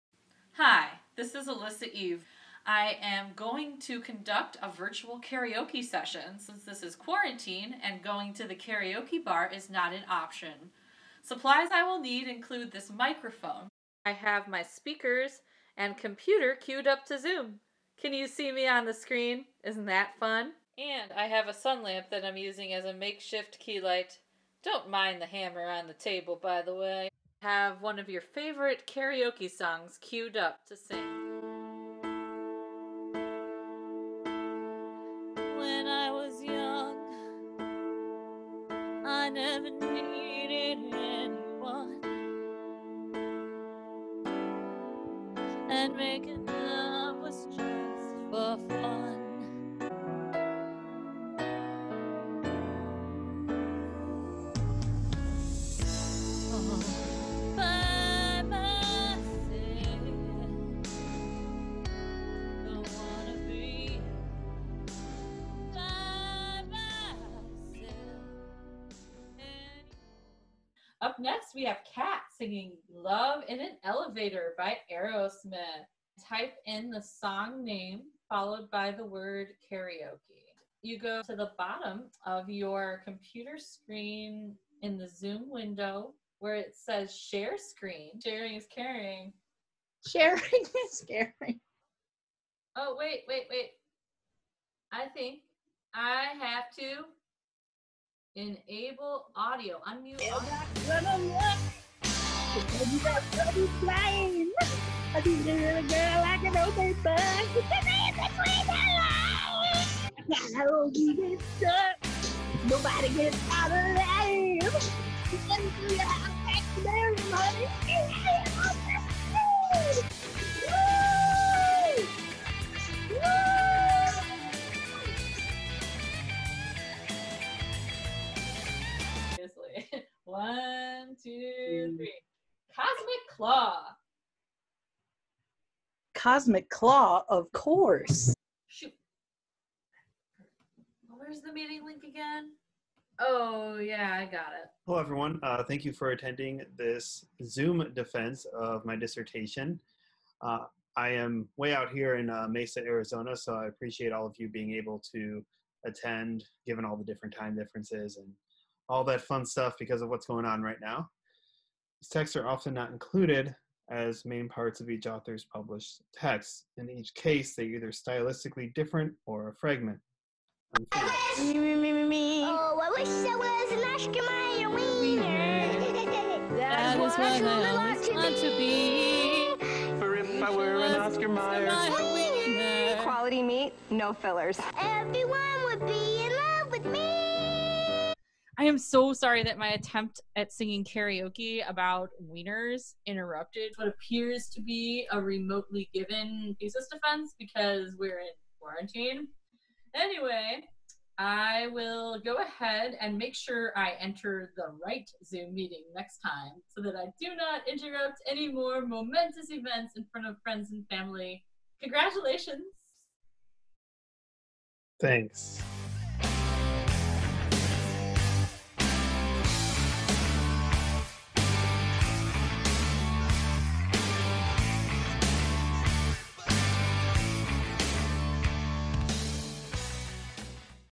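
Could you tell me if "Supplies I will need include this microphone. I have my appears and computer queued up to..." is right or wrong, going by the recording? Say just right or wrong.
wrong.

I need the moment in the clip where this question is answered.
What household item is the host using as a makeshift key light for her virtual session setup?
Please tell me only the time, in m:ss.
0:21.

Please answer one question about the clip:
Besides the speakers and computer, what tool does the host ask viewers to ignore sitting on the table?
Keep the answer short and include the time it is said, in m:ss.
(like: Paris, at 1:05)
hammer, at 0:25.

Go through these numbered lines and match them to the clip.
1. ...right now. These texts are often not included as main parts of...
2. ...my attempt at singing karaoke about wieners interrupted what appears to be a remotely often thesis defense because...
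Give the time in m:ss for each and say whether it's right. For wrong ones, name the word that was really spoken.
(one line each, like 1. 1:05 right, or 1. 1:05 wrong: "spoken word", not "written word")
1. 2:40 right
2. 3:09 wrong: "given", not "often".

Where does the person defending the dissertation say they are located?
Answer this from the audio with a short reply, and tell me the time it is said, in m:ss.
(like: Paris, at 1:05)
Mesa, Arizona, at 2:32.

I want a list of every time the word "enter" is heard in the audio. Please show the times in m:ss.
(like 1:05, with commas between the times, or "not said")
3:23.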